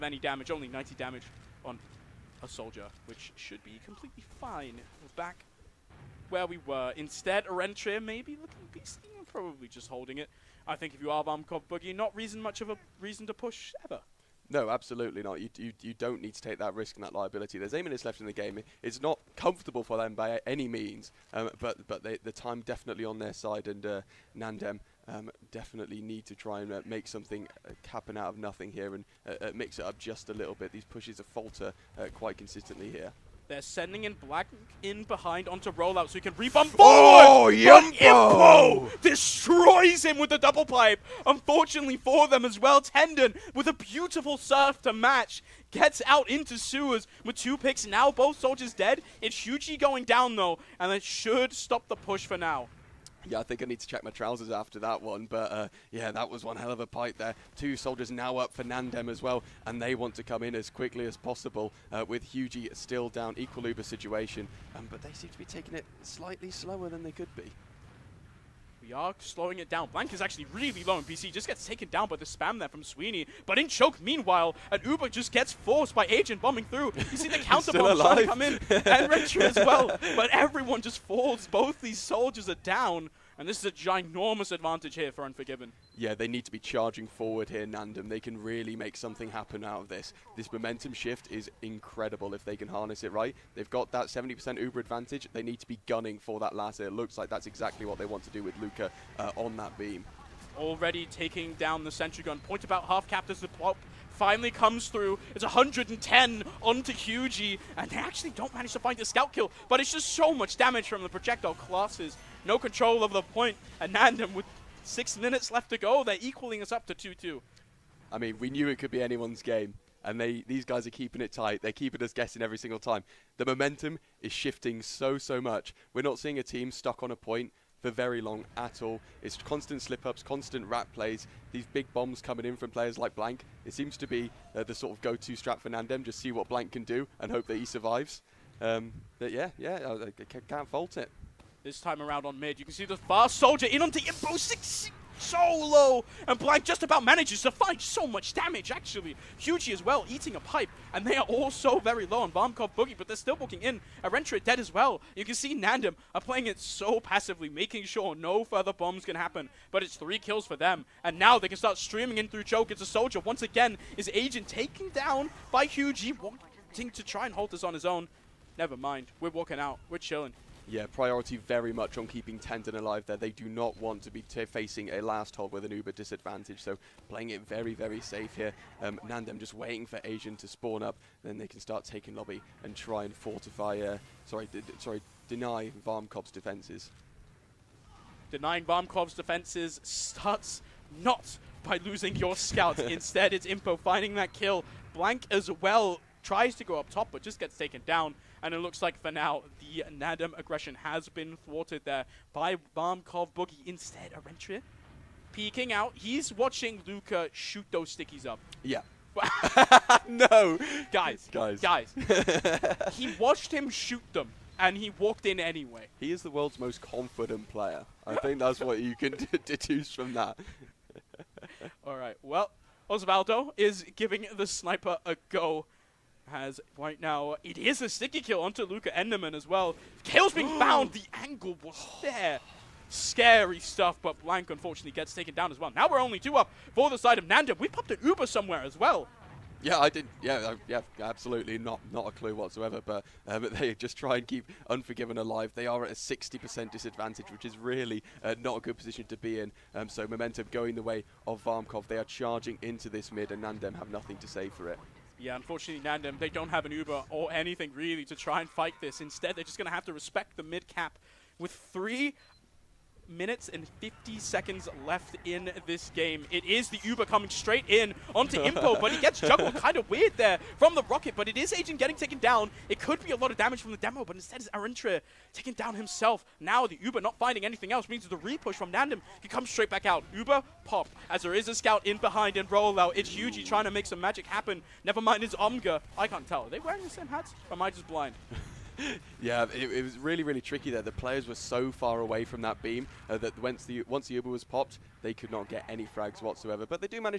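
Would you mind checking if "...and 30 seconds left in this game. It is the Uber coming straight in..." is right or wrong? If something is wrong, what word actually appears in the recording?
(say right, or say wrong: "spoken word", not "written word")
wrong: "50", not "30".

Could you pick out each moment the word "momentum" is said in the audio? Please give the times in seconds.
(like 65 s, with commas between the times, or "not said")
90 s, 123 s, 250 s.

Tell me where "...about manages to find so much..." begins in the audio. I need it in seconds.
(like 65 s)
146 s.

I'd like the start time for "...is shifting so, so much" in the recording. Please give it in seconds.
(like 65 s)
124 s.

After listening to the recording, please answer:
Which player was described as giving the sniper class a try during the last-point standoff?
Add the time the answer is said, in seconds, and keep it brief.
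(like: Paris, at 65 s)
Osvaldo, at 222 s.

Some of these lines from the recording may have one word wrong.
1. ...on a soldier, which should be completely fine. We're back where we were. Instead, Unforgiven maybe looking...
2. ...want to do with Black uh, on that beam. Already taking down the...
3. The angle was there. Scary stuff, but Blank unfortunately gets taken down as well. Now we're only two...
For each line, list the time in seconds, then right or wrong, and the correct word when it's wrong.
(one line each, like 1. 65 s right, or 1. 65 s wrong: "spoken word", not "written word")
1. 1 s wrong: "Arentria", not "Unforgiven"
2. 98 s wrong: "Luca", not "Black"
3. 230 s right.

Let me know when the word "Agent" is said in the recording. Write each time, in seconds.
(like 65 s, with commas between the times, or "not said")
76 s, 164 s, 271 s.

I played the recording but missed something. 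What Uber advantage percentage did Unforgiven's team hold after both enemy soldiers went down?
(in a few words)
70%.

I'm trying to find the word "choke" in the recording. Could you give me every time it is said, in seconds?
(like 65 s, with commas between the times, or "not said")
73 s, 162 s.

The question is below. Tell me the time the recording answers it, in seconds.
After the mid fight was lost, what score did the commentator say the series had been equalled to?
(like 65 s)
116 s.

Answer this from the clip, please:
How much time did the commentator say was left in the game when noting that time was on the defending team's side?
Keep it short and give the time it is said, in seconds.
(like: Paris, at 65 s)
8 minutes, at 17 s.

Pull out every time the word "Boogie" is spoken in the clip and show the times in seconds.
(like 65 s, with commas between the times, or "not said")
11 s, 152 s, 203 s.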